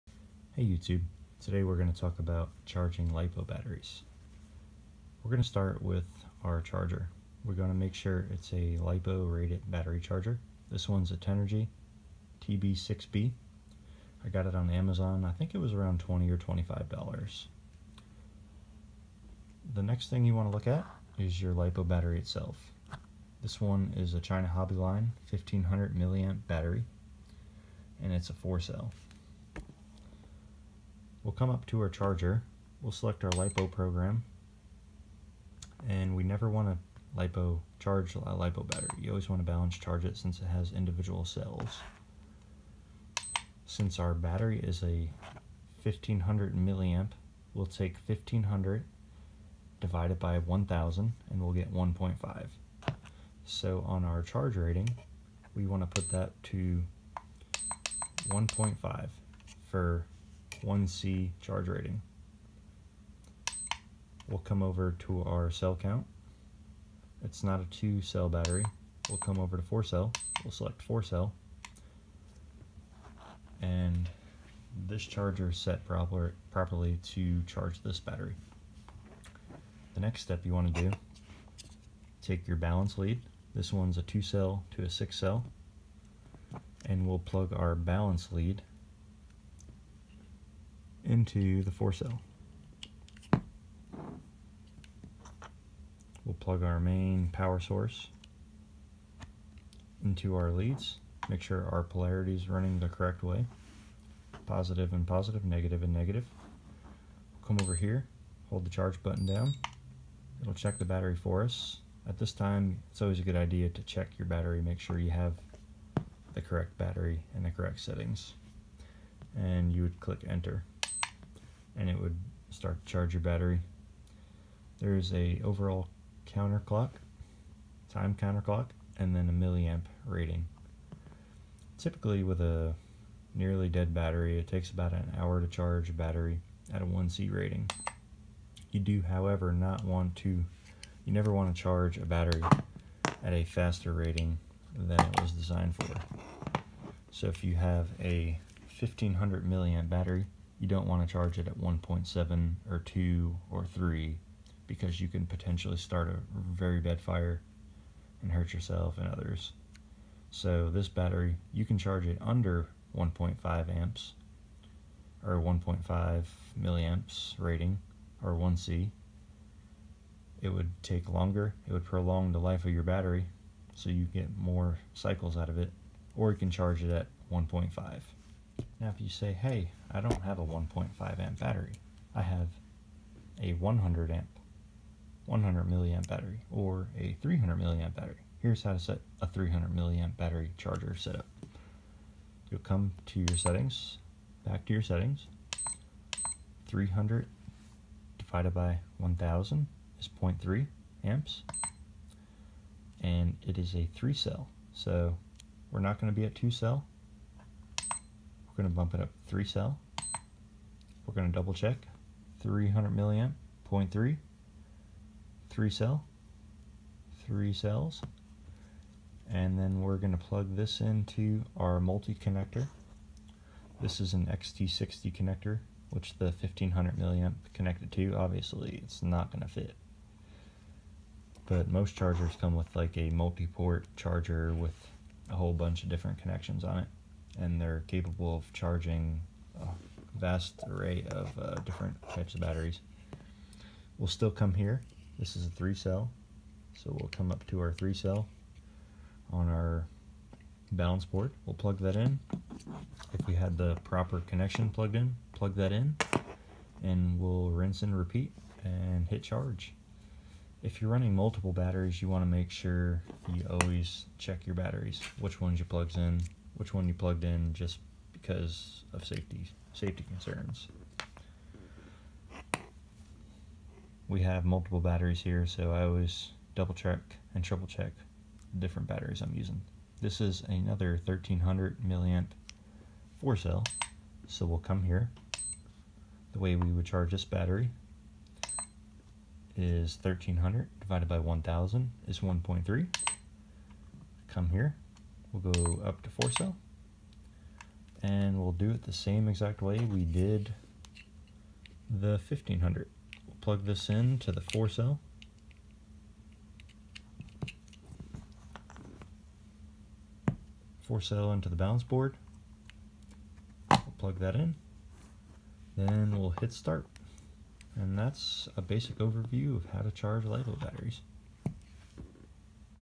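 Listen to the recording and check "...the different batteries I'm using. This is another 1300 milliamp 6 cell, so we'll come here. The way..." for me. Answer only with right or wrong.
wrong.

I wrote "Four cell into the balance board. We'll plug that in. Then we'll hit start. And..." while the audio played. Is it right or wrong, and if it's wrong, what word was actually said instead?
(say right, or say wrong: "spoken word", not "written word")
right.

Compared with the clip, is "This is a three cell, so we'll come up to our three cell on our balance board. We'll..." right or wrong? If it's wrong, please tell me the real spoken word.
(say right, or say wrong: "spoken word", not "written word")
right.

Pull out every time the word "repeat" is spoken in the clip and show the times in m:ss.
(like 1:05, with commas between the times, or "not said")
4:17.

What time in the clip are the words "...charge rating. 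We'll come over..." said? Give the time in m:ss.
1:01.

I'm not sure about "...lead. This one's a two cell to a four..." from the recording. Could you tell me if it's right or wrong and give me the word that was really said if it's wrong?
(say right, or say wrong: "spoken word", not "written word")
wrong: "six", not "four".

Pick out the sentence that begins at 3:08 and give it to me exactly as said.
Here's how to set a 300 milliamp battery charger setup.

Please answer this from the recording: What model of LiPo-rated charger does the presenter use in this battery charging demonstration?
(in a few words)
Tenergy TB6B.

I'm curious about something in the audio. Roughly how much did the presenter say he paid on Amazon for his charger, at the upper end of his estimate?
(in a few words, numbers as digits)
$25.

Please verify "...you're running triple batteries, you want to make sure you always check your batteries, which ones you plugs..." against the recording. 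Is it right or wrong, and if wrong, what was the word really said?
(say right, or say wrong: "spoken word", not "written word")
wrong: "multiple", not "triple".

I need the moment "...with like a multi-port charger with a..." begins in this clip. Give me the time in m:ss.
3:52.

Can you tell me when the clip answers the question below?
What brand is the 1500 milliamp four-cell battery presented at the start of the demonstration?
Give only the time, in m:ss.
0:24.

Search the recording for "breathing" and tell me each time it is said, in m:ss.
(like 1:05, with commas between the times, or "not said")
not said.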